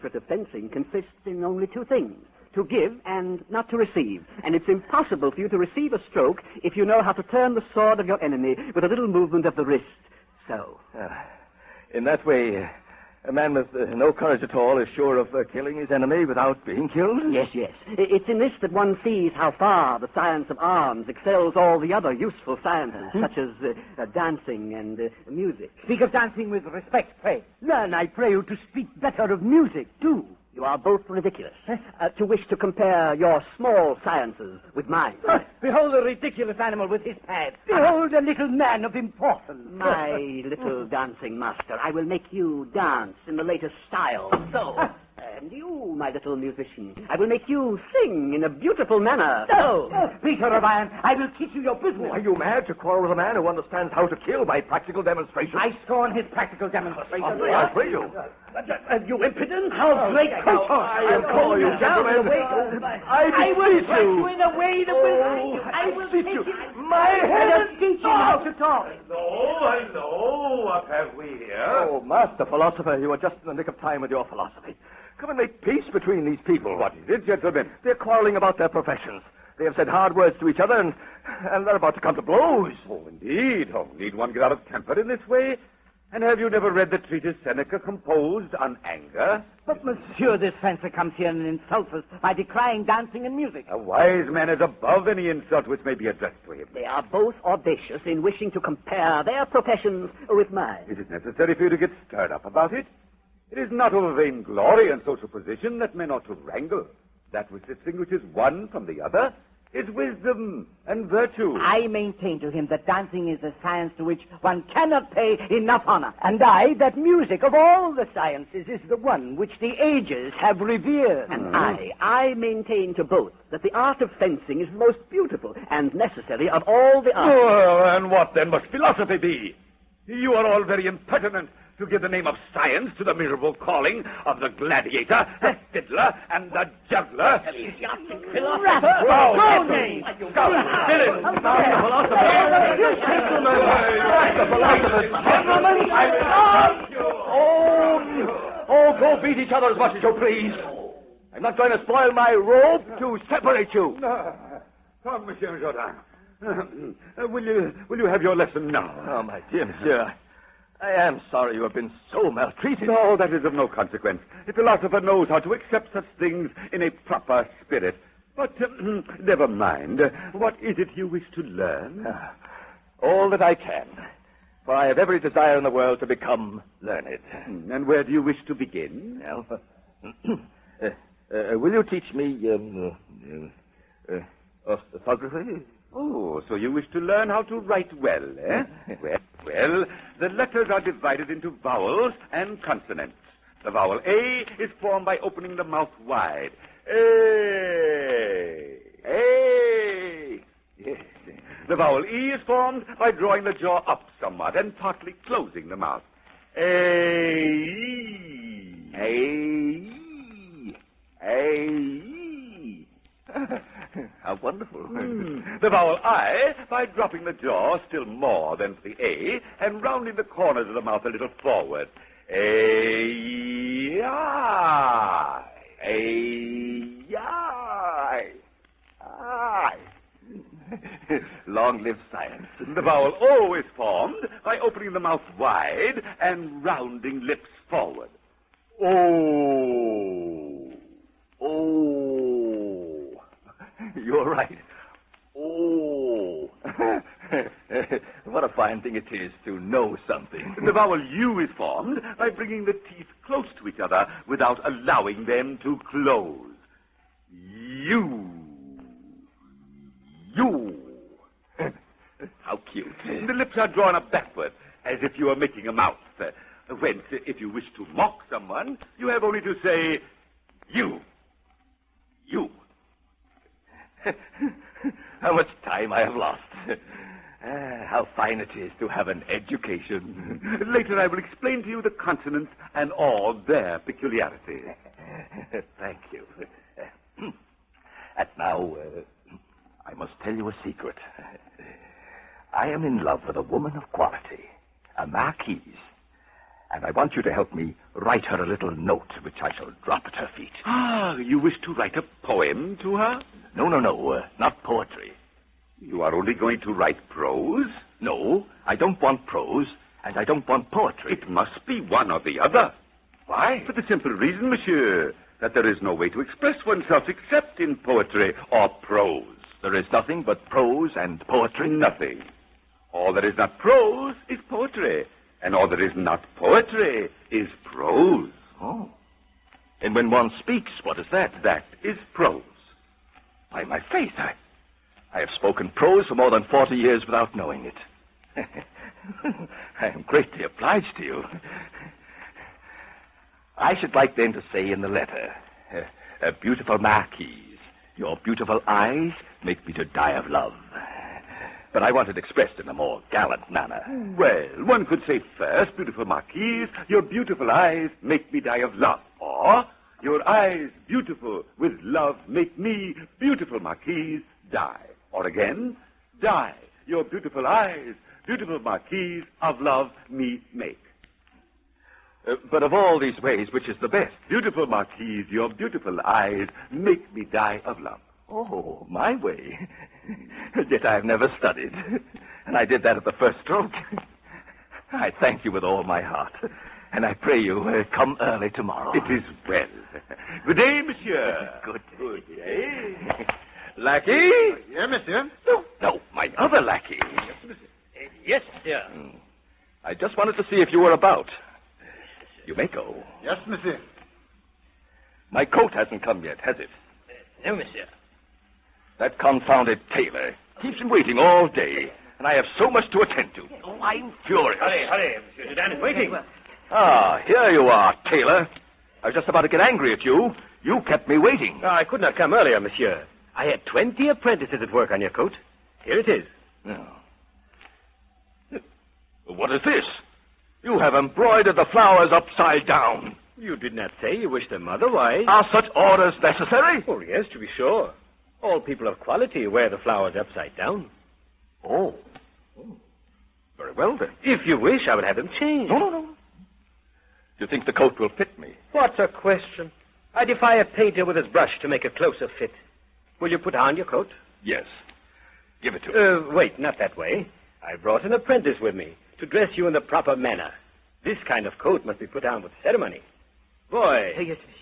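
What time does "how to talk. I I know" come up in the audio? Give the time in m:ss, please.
1:08.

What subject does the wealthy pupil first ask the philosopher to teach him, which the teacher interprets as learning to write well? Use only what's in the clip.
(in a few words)
Orthography.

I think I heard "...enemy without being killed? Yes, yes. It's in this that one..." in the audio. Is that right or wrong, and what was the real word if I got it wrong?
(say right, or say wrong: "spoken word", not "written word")
right.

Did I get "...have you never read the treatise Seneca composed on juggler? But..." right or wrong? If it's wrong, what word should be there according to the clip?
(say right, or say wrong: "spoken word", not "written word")
wrong: "anger", not "juggler".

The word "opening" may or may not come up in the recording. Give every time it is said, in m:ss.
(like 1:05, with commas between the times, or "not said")
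3:15, 3:54.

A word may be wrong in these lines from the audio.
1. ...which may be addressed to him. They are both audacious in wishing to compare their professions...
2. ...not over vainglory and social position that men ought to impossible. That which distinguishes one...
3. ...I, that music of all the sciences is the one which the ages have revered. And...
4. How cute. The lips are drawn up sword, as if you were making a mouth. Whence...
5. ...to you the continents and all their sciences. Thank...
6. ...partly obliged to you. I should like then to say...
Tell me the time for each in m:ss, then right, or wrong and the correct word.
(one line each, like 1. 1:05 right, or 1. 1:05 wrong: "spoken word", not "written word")
1. 1:35 right
2. 1:43 wrong: "wrangle", not "impossible"
3. 1:56 right
4. 4:22 wrong: "backward", not "sword"
5. 4:41 wrong: "peculiarities", not "sciences"
6. 5:40 wrong: "greatly", not "partly".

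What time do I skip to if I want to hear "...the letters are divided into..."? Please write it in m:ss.
3:10.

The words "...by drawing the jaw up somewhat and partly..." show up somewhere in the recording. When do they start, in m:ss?
3:22.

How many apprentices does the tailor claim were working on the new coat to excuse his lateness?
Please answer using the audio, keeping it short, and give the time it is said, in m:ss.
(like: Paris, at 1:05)
20, at 7:03.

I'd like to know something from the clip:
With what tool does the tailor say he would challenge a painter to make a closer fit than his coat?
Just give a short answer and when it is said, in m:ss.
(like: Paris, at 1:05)
His brush, at 7:31.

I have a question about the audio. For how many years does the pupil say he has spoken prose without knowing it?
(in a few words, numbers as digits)
40.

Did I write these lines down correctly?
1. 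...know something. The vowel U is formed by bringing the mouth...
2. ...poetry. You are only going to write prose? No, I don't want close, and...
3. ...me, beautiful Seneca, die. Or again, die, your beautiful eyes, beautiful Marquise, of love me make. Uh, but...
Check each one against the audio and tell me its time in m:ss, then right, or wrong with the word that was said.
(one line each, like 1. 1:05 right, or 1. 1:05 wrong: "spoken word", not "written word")
1. 4:09 wrong: "teeth", not "mouth"
2. 5:04 wrong: "prose", not "close"
3. 6:02 wrong: "Marquise", not "Seneca".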